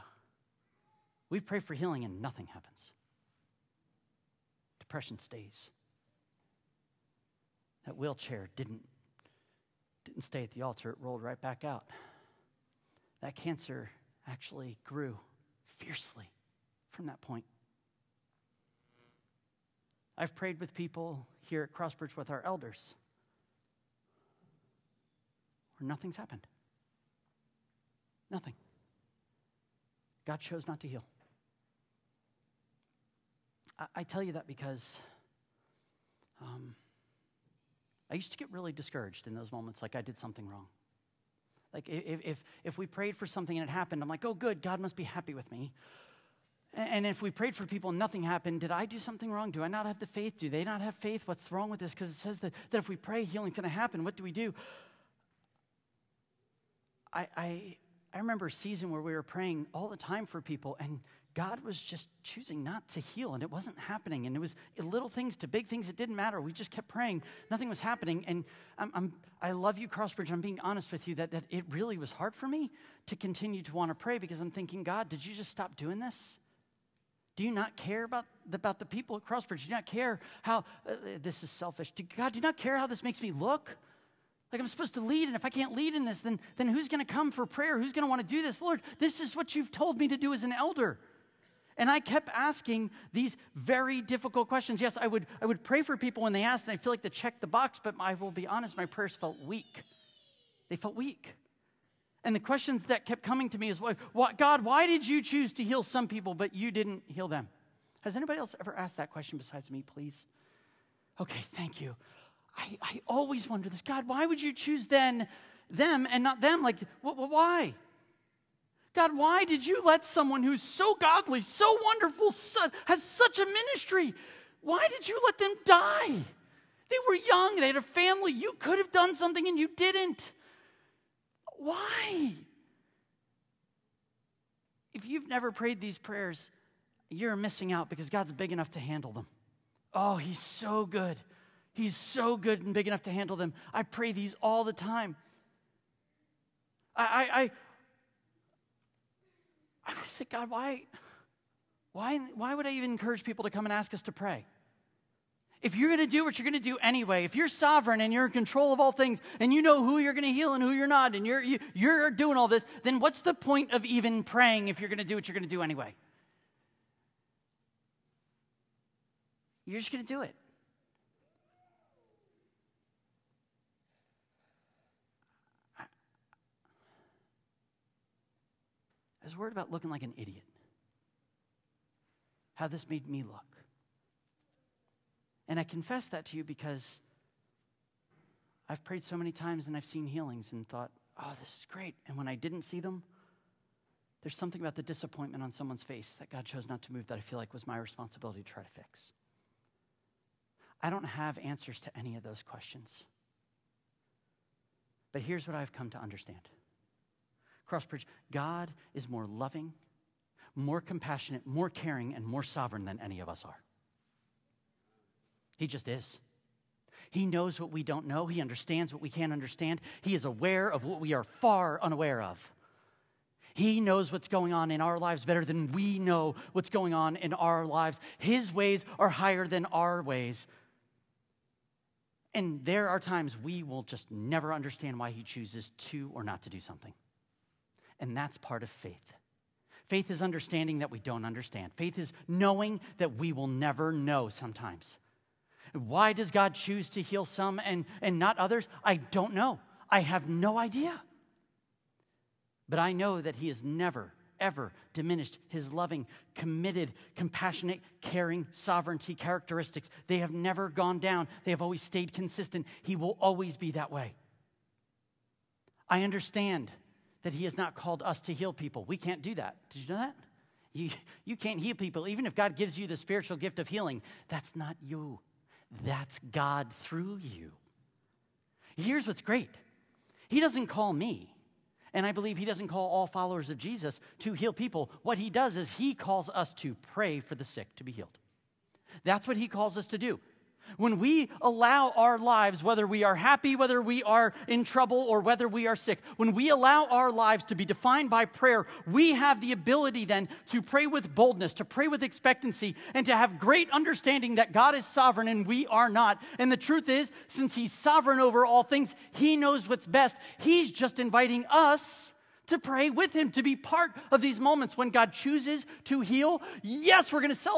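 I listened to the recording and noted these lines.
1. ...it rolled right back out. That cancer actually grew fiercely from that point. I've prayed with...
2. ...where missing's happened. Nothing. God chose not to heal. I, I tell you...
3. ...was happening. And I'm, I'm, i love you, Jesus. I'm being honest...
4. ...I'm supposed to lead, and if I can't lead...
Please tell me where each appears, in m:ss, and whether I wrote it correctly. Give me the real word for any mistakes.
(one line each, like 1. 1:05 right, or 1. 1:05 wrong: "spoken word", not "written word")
1. 0:10 right
2. 0:25 wrong: "nothing", not "missing"
3. 1:07 wrong: "Crossbridge", not "Jesus"
4. 1:24 right.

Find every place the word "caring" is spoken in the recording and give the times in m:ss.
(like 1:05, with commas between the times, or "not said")
3:31, 4:18.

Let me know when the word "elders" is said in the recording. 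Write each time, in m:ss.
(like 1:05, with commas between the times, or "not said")
0:22, 1:30.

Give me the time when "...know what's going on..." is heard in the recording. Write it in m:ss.
3:45.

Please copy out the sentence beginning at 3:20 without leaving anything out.
I don't have answers to any of those questions.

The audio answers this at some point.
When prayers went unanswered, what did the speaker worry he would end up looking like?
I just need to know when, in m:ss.
3:00.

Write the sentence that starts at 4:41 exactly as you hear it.
And I believe he doesn't call all followers of Jesus to heal people.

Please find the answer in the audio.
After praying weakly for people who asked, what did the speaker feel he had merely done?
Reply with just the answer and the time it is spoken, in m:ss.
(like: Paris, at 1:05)
checked the box, at 1:37.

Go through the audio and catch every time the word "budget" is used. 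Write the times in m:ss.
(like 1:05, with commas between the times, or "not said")
not said.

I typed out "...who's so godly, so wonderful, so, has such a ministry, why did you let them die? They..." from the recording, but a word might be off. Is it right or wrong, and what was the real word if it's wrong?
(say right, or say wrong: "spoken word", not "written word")
right.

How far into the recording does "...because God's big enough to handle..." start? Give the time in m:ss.
2:17.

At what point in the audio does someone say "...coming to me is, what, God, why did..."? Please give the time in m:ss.
1:43.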